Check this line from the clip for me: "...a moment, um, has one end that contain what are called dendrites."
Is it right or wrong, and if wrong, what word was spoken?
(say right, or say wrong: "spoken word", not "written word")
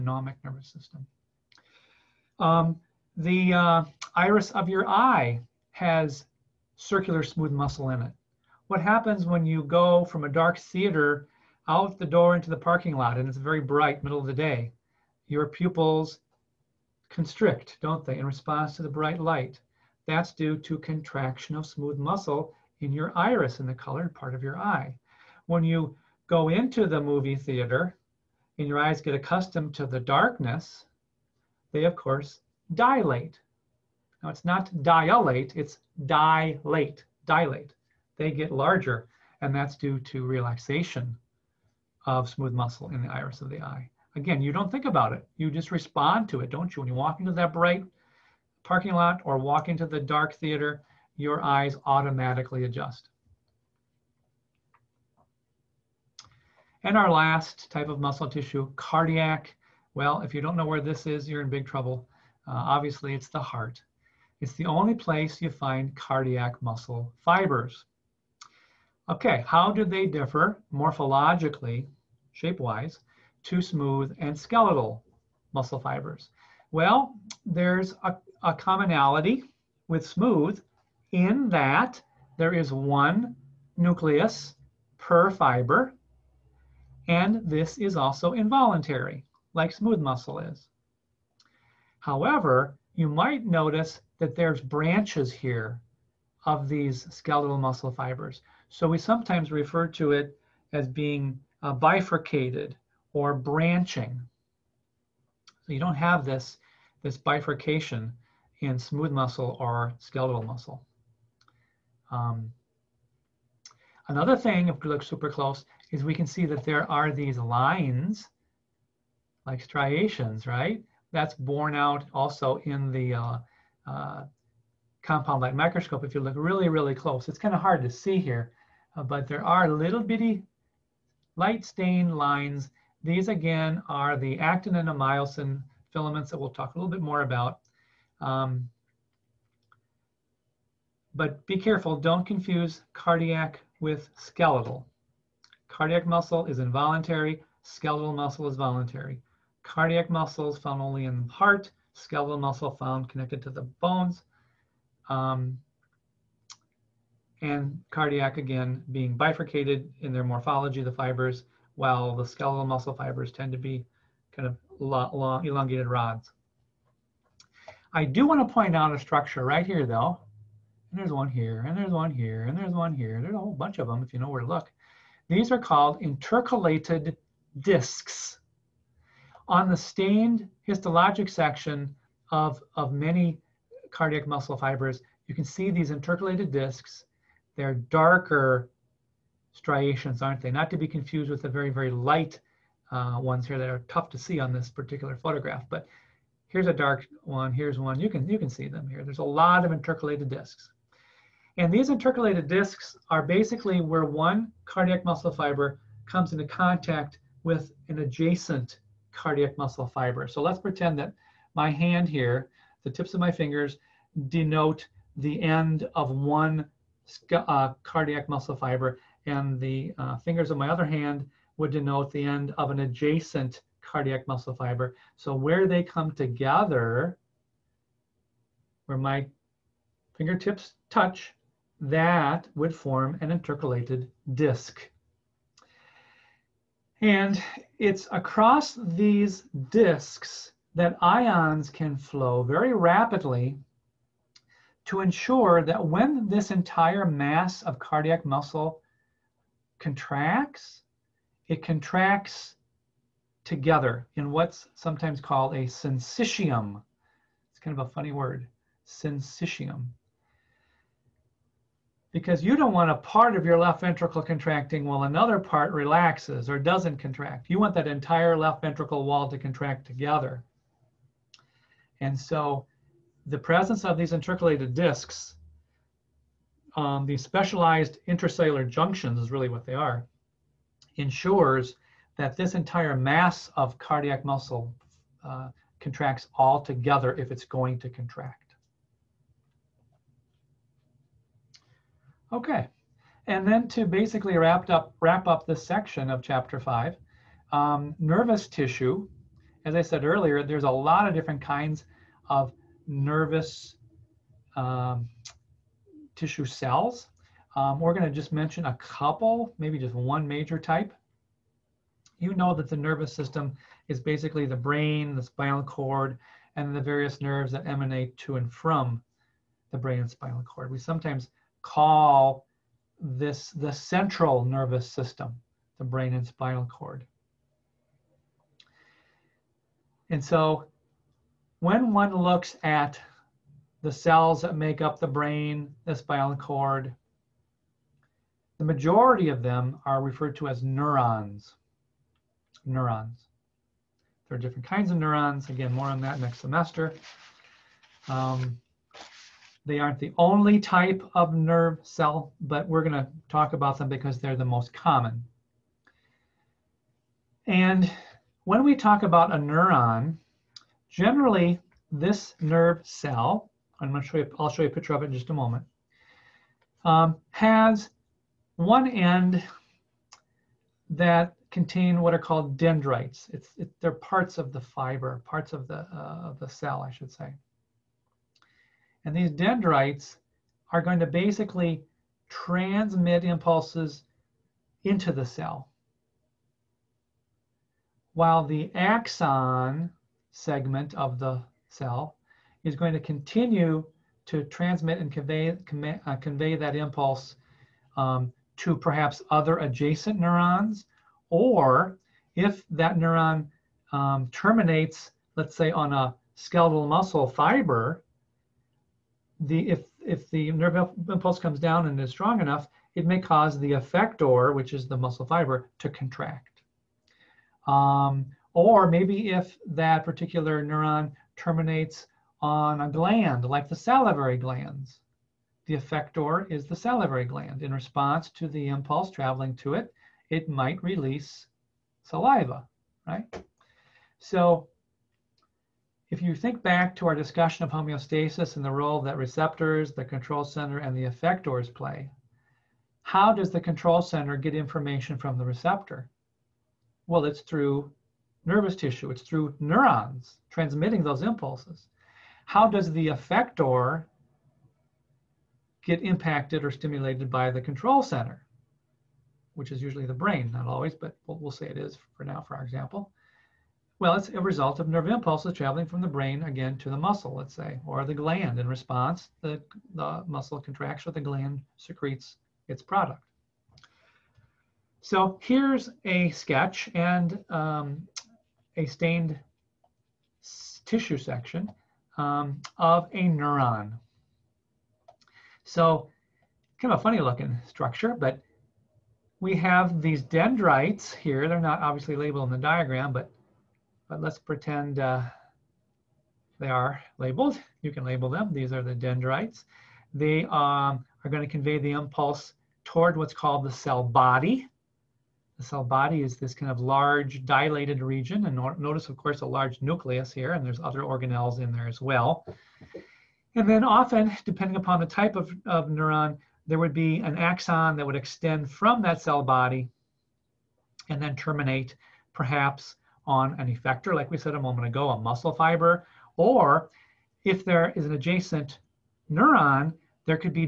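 right.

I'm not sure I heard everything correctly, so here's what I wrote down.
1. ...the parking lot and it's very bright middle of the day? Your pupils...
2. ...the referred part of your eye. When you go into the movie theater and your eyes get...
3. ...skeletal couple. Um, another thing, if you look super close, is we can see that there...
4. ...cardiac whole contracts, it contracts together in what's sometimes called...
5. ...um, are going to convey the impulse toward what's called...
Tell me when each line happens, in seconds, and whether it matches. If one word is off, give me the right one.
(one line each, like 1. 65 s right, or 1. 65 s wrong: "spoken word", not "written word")
1. 12 s right
2. 23 s wrong: "colored", not "referred"
3. 109 s wrong: "muscle", not "couple"
4. 247 s wrong: "muscle", not "whole"
5. 500 s right.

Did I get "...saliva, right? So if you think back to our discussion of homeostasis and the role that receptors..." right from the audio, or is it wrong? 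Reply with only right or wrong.
right.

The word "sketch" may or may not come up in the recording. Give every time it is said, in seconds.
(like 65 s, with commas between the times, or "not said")
476 s.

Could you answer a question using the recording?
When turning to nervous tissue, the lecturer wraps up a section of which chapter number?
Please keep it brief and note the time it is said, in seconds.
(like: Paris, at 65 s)
5, at 296 s.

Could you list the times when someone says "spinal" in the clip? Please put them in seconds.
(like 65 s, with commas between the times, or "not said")
315 s, 320 s, 326 s, 335 s.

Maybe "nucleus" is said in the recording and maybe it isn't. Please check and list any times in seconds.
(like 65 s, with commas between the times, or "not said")
83 s, 509 s.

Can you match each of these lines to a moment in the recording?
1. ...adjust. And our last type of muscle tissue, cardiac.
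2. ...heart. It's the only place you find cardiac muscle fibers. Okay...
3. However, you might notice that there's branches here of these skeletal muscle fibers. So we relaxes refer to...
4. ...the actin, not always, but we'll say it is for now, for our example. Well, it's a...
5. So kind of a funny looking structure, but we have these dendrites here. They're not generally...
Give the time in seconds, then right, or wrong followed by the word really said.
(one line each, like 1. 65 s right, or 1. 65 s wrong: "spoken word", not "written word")
1. 52 s right
2. 63 s right
3. 91 s wrong: "sometimes", not "relaxes"
4. 460 s wrong: "brain", not "actin"
5. 485 s wrong: "obviously", not "generally".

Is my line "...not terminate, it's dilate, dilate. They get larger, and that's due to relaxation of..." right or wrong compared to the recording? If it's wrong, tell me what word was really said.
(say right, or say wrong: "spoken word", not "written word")
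wrong: "dilate", not "terminate".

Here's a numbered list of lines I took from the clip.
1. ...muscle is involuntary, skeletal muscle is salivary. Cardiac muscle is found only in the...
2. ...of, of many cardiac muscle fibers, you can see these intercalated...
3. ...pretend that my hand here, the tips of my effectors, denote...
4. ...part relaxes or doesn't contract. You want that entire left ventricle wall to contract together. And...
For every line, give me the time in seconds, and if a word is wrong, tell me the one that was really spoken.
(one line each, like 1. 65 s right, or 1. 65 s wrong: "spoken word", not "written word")
1. 146 s wrong: "voluntary", not "salivary"
2. 182 s right
3. 210 s wrong: "fingers", not "effectors"
4. 265 s right.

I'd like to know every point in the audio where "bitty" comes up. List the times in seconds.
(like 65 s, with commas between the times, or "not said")
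130 s.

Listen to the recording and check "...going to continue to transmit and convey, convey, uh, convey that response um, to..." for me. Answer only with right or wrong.
wrong.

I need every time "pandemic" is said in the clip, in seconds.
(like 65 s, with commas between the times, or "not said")
not said.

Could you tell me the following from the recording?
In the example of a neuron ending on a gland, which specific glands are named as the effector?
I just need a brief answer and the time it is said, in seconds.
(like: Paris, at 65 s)
salivary glands, at 423 s.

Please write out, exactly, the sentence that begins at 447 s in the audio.
Well, it's through nervous tissue, it's through neurons transmitting those impulses.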